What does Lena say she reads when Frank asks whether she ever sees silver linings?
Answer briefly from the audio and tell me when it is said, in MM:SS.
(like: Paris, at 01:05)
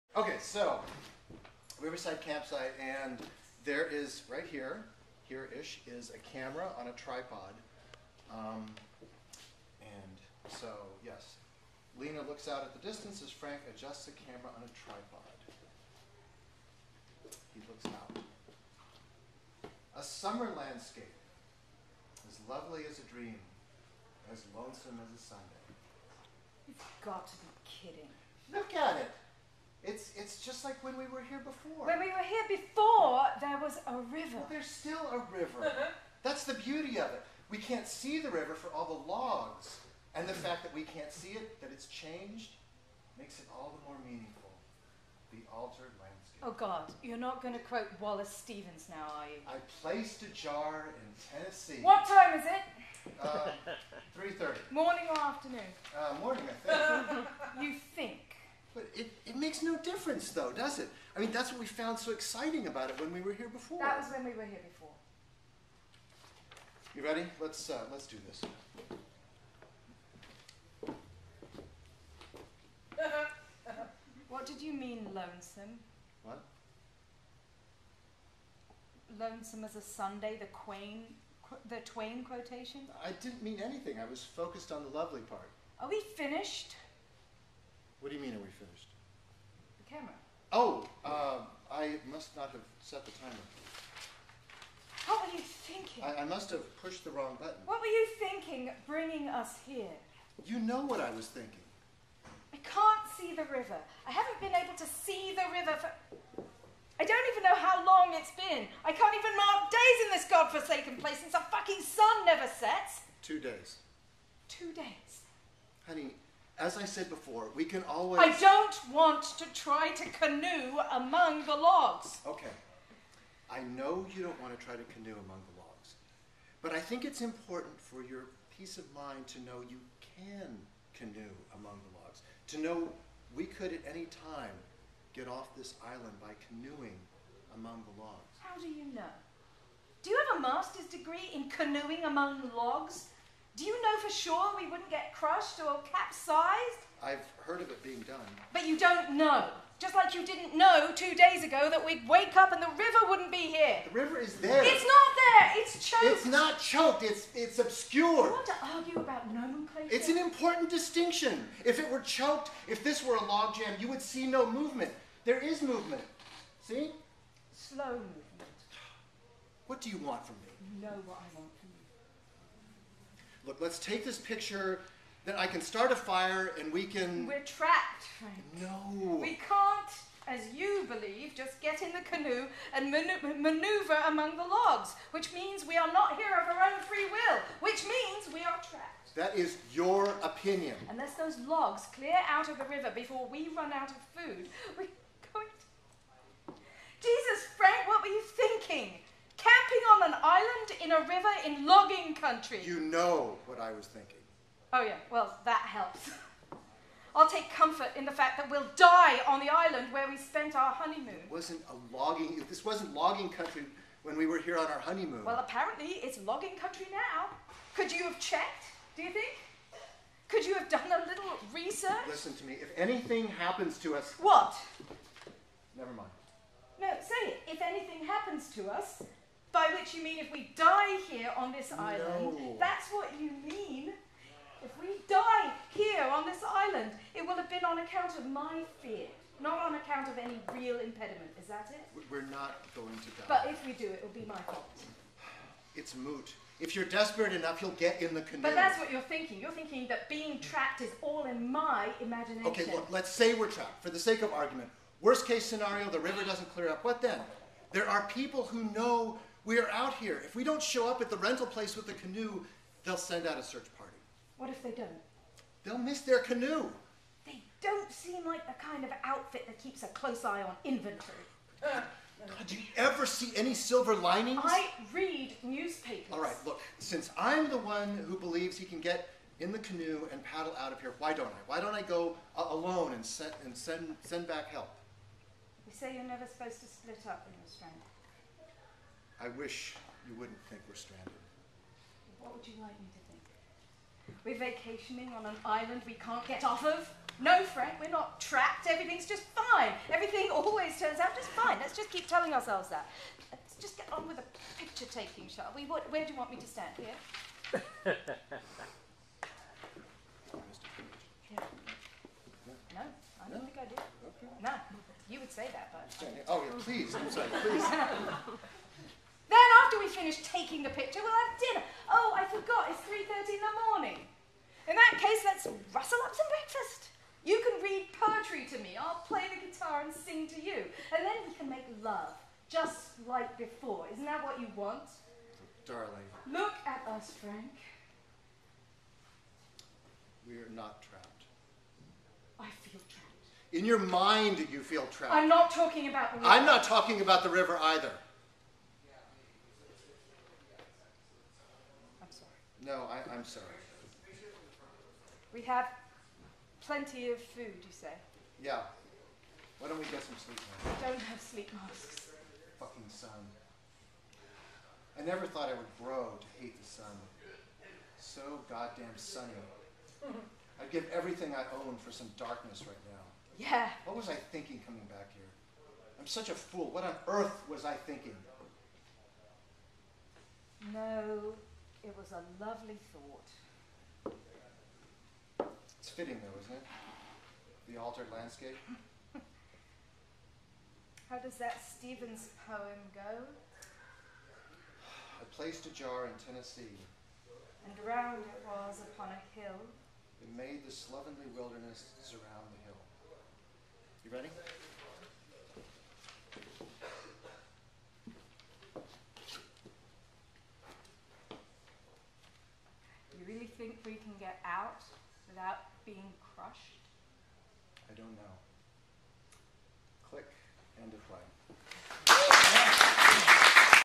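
newspapers, at 04:35.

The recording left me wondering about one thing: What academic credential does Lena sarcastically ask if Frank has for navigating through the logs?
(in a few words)
master's degree.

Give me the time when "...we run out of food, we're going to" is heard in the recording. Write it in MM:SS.
03:13.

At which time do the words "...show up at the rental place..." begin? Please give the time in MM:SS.
04:20.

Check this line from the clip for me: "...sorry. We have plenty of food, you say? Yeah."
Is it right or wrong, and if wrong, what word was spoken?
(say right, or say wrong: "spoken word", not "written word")
right.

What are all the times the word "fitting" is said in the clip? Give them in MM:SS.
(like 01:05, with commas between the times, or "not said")
06:25.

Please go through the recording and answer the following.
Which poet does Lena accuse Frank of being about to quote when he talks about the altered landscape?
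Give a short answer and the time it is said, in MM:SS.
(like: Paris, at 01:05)
Wallace Stevens, at 00:48.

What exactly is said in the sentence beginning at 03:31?
It wasn't a logging, this wasn't logging country when we were here on our honeymoon.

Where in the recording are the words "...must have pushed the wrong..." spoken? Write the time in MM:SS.
01:36.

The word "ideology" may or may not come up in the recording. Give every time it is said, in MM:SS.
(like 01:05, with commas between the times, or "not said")
not said.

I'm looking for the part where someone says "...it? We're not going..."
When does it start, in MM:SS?
04:01.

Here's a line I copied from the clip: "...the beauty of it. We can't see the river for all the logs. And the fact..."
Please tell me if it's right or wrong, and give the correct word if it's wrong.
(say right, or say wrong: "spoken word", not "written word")
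right.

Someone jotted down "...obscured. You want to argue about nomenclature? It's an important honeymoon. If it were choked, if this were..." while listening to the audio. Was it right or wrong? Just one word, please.
wrong.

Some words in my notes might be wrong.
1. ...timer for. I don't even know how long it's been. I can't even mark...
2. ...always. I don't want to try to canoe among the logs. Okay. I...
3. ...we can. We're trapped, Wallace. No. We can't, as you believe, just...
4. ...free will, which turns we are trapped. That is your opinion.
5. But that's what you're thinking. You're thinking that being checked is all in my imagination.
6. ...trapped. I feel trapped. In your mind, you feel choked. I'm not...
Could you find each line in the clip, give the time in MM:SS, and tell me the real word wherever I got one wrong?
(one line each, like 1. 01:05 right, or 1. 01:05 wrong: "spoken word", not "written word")
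1. 01:45 wrong: "river", not "timer"
2. 01:57 right
3. 02:56 wrong: "Frank", not "Wallace"
4. 03:06 wrong: "means", not "turns"
5. 04:08 wrong: "trapped", not "checked"
6. 05:40 wrong: "trapped", not "choked".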